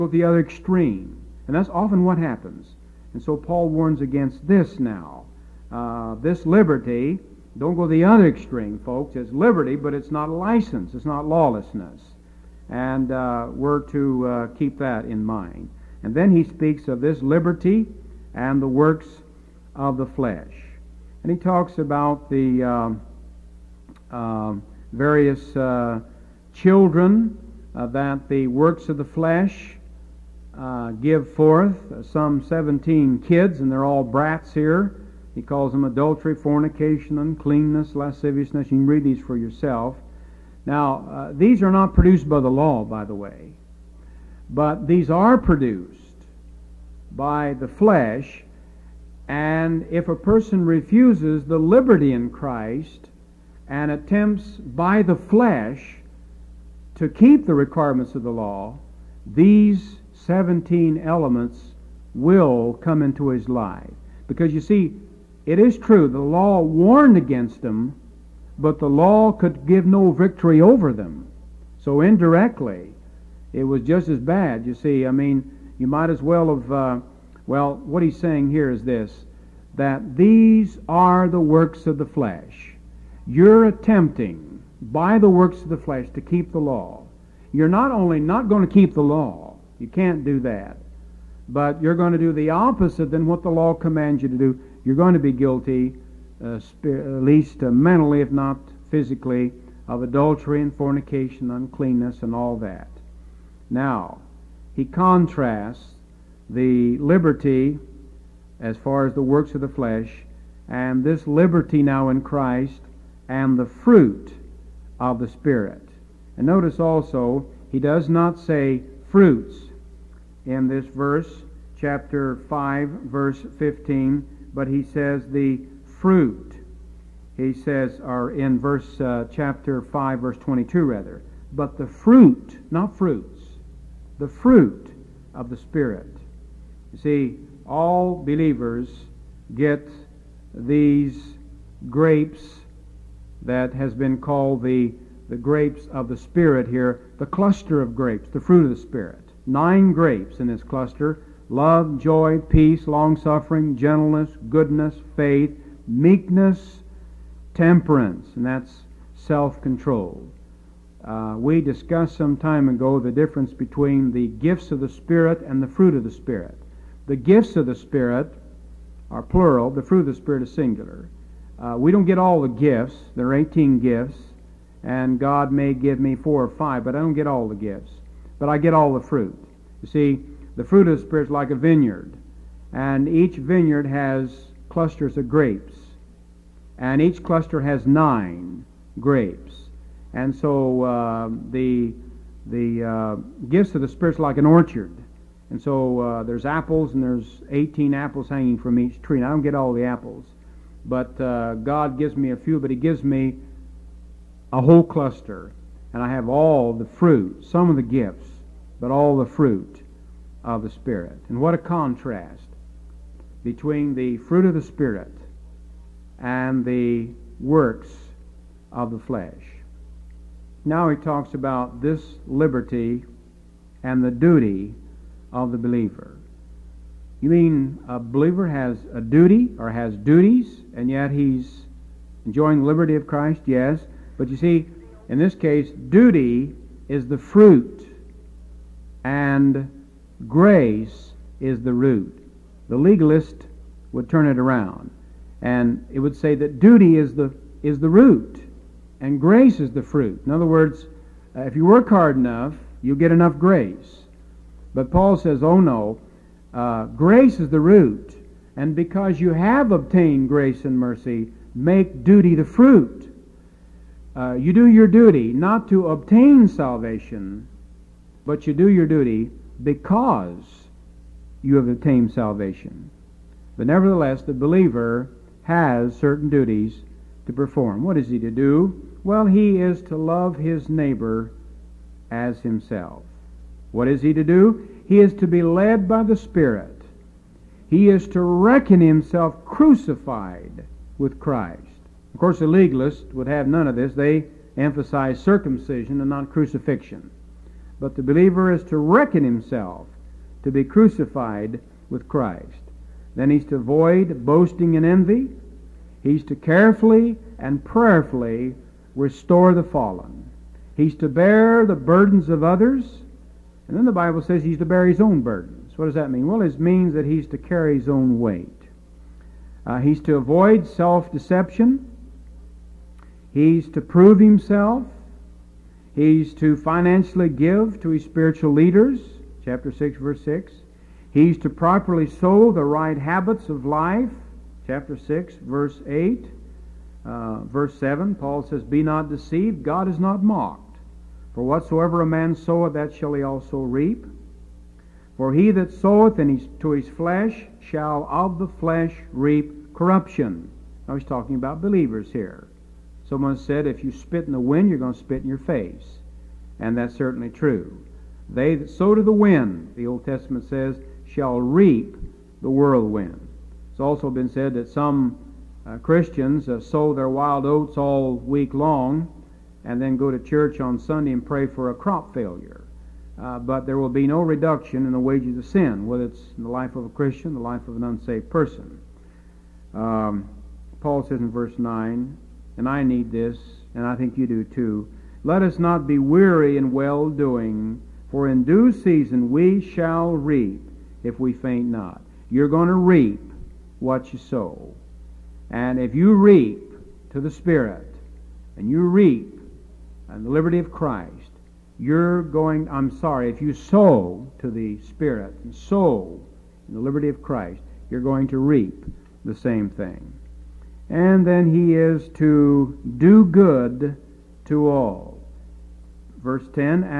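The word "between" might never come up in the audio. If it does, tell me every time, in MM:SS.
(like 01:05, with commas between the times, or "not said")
02:43, 03:33.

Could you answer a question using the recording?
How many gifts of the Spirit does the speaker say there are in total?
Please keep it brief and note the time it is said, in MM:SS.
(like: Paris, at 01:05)
18, at 02:53.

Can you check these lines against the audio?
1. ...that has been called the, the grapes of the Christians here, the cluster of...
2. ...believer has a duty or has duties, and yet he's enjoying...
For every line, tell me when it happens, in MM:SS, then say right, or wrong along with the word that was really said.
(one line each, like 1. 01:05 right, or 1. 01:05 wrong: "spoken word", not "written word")
1. 02:23 wrong: "Spirit", not "Christians"
2. 03:47 right.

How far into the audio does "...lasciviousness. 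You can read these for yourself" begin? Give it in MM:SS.
00:37.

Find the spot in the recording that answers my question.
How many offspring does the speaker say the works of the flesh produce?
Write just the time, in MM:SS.
00:32.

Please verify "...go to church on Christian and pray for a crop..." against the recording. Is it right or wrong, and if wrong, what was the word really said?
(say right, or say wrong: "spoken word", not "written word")
wrong: "Sunday", not "Christian".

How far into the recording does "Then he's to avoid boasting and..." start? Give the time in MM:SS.
05:03.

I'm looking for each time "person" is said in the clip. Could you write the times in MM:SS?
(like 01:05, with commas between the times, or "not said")
00:50, 06:18.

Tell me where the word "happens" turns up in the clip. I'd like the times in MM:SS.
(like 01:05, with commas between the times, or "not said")
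00:02.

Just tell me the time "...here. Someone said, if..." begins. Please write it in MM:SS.
05:52.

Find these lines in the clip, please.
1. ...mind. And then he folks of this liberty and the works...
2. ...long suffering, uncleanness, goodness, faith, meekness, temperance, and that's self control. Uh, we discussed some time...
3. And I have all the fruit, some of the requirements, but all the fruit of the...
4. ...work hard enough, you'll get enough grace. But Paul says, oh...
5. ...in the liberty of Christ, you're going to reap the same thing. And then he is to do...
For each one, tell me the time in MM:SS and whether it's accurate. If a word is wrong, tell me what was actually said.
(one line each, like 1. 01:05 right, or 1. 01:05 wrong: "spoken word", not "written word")
1. 00:15 wrong: "speaks", not "folks"
2. 02:32 wrong: "gentleness", not "uncleanness"
3. 03:25 wrong: "gifts", not "requirements"
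4. 04:11 right
5. 06:46 right.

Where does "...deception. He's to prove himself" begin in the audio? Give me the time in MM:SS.
05:21.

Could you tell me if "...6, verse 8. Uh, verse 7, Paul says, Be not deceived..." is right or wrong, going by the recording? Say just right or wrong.
right.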